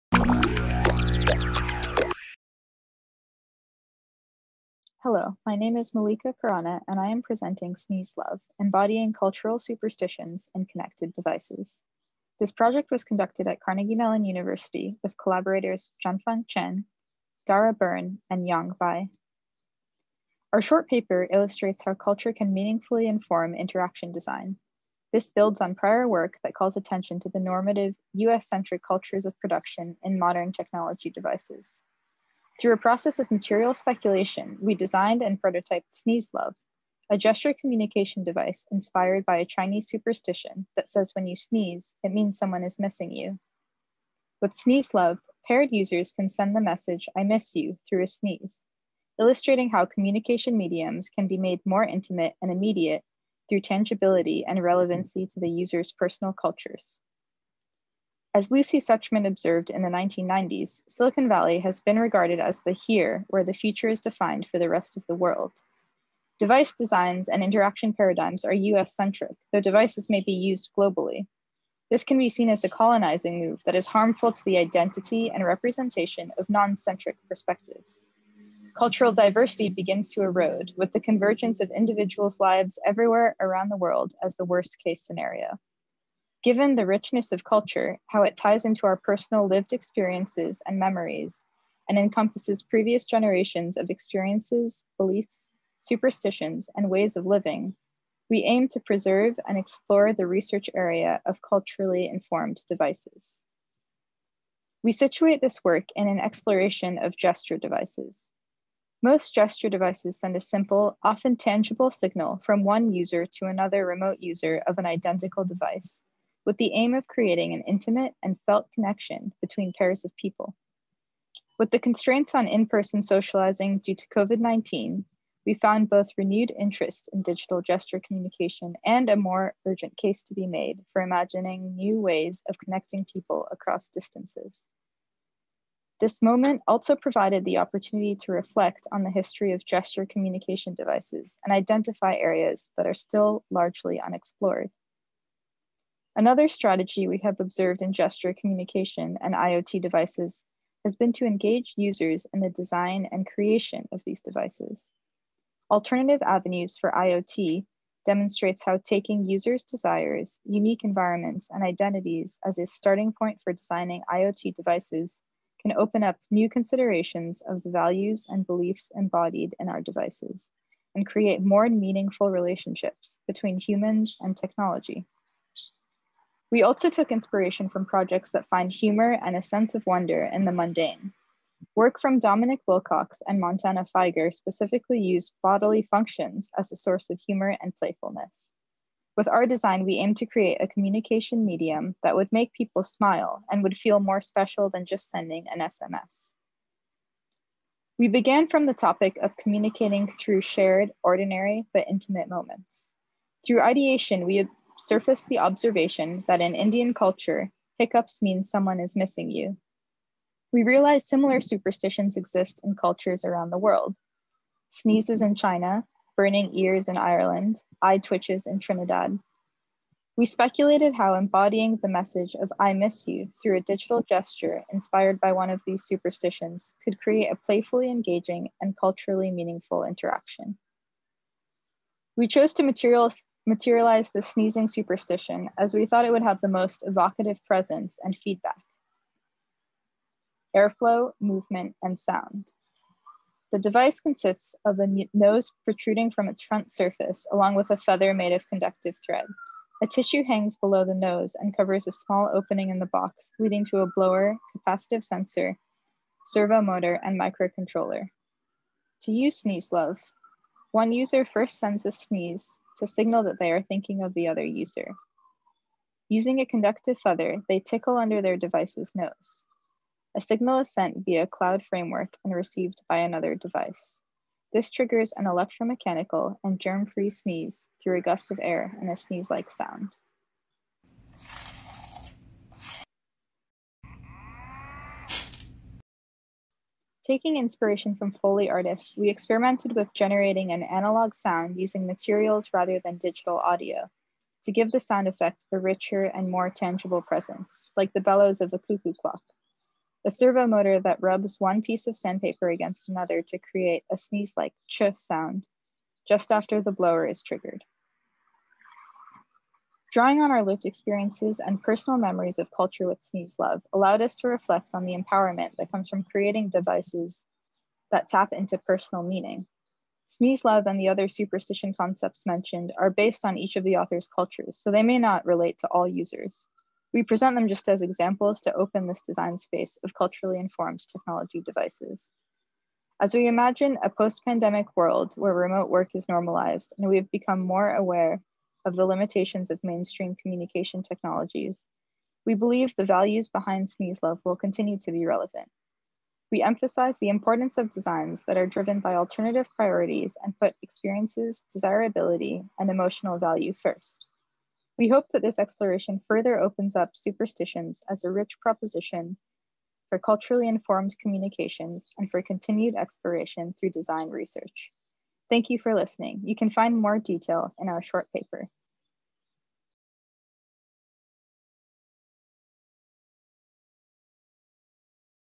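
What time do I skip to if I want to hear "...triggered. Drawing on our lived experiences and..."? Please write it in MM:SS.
05:07.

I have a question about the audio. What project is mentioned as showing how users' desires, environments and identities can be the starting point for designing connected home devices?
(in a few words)
Alternative Avenues for IoT.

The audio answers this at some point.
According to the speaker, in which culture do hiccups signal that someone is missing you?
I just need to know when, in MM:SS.
03:26.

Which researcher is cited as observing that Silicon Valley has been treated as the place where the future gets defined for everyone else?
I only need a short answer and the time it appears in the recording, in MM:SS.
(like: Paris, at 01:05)
Lucy Suchman, at 00:58.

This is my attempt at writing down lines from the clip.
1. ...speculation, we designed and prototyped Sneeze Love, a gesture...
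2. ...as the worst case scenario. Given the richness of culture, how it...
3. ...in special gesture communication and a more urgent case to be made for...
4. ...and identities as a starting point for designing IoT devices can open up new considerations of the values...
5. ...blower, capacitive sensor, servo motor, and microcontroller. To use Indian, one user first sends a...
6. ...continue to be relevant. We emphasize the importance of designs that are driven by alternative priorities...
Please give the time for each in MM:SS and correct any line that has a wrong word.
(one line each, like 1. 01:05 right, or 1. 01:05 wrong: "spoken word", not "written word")
1. 00:33 right
2. 01:24 right
3. 02:07 wrong: "digital", not "special"
4. 02:41 right
5. 04:13 wrong: "Love", not "Indian"
6. 05:44 right.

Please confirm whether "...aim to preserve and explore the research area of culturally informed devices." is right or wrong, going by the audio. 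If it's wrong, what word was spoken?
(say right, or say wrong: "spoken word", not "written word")
right.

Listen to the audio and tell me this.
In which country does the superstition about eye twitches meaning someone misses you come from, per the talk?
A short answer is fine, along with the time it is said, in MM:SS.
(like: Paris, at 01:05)
Trinidad, at 03:38.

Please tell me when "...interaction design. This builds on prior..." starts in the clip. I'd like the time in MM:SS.
00:23.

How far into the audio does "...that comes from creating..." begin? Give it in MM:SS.
05:15.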